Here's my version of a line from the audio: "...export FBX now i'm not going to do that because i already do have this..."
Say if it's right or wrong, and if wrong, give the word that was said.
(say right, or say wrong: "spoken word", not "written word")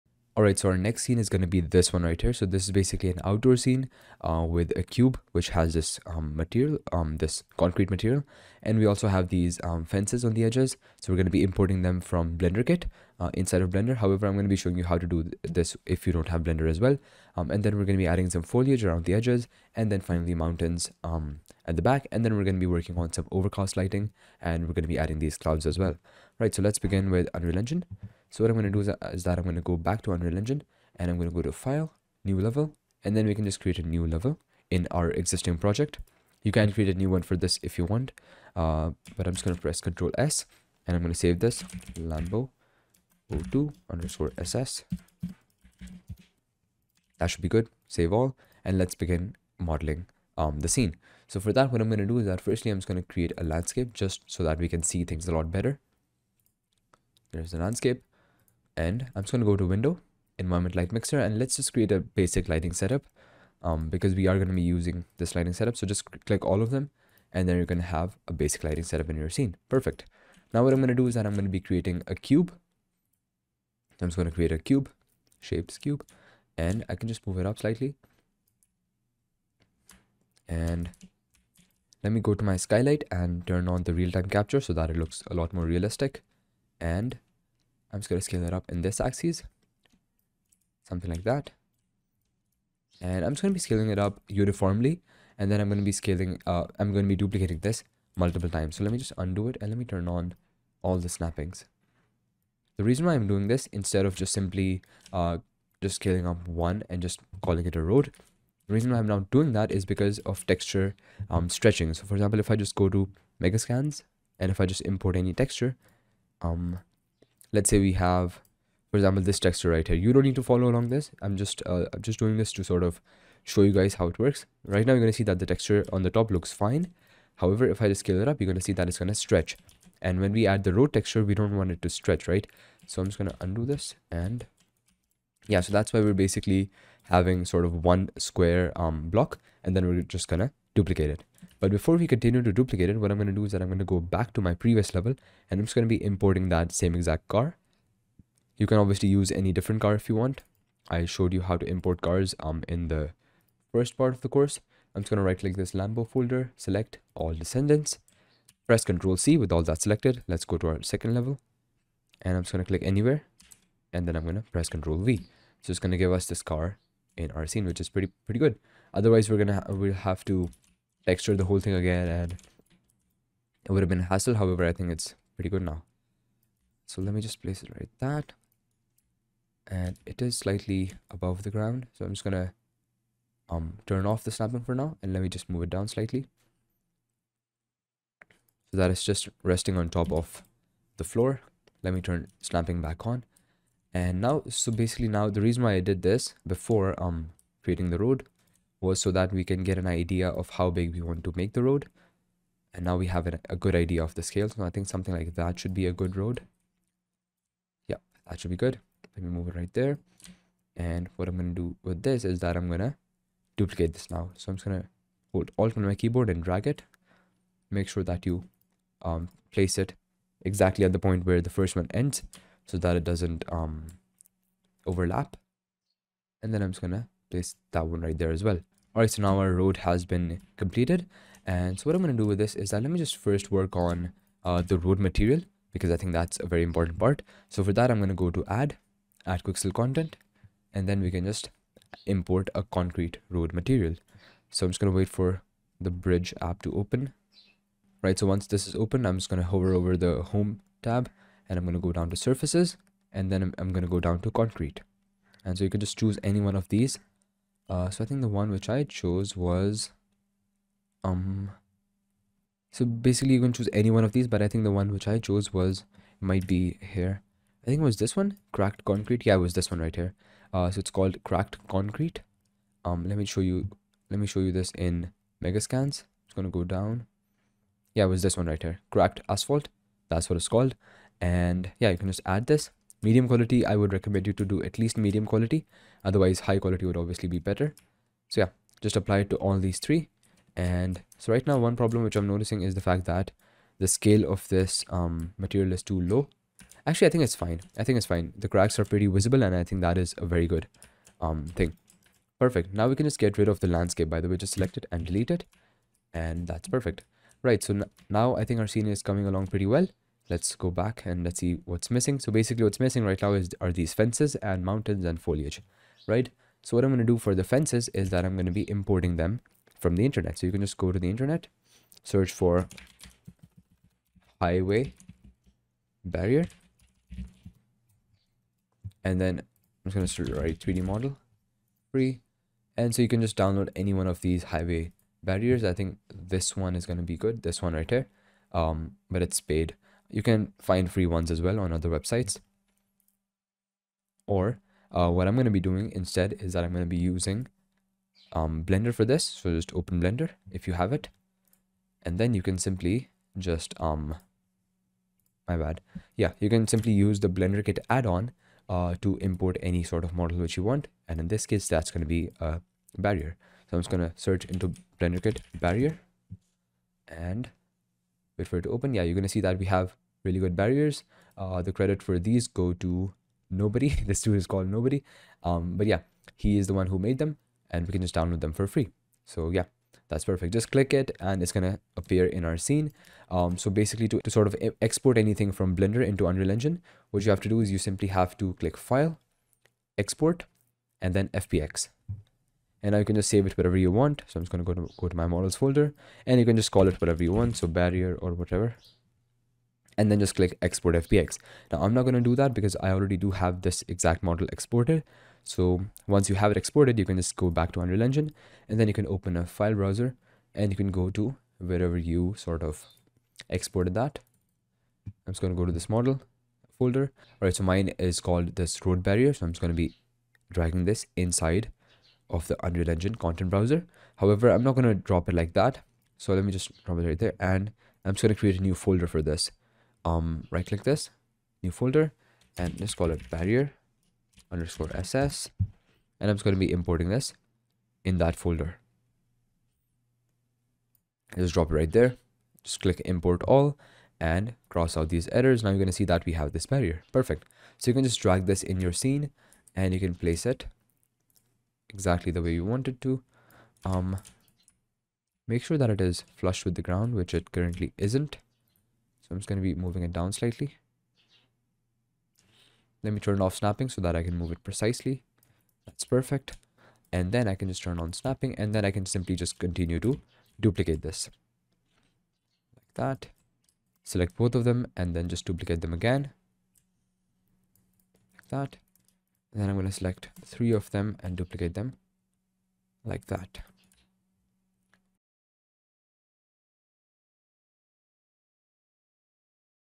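right.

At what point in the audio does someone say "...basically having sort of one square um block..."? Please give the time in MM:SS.
02:16.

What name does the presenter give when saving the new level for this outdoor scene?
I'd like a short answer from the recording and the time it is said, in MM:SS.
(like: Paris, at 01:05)
Lambo 02_SS, at 00:41.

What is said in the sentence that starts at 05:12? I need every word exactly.
So basically what's missing right now is are these fences and mountains and foliage, right?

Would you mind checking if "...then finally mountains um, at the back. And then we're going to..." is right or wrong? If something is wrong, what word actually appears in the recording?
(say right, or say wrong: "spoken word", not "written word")
right.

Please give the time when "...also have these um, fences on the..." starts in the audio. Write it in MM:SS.
00:08.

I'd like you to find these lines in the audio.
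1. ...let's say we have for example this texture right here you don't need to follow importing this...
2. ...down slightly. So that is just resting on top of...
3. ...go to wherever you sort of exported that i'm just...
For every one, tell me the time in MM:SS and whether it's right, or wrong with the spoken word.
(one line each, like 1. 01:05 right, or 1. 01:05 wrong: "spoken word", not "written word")
1. 01:57 wrong: "along", not "importing"
2. 03:05 right
3. 06:50 right.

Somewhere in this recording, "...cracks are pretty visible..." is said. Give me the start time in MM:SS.
04:58.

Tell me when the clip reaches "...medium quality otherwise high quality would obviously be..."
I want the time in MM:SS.
04:44.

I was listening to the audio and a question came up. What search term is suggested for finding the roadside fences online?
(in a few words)
Highway barrier.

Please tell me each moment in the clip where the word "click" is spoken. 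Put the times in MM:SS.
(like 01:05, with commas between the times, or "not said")
01:06, 02:35, 02:42, 06:20, 06:28, 06:40, 07:10, 07:22.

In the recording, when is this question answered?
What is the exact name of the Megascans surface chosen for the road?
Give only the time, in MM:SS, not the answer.
04:38.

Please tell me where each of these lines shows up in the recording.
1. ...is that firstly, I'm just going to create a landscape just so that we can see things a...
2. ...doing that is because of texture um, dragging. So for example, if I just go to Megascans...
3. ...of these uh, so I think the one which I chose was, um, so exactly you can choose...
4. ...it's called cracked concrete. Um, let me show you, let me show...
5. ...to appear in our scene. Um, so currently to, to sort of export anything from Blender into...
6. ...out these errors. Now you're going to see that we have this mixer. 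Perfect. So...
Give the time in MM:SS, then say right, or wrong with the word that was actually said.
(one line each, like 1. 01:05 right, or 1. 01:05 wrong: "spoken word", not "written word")
1. 00:52 right
2. 01:49 wrong: "stretching", not "dragging"
3. 04:16 wrong: "basically", not "exactly"
4. 04:30 right
5. 06:21 wrong: "basically", not "currently"
6. 07:24 wrong: "barrier", not "mixer".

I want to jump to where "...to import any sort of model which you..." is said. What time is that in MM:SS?
05:59.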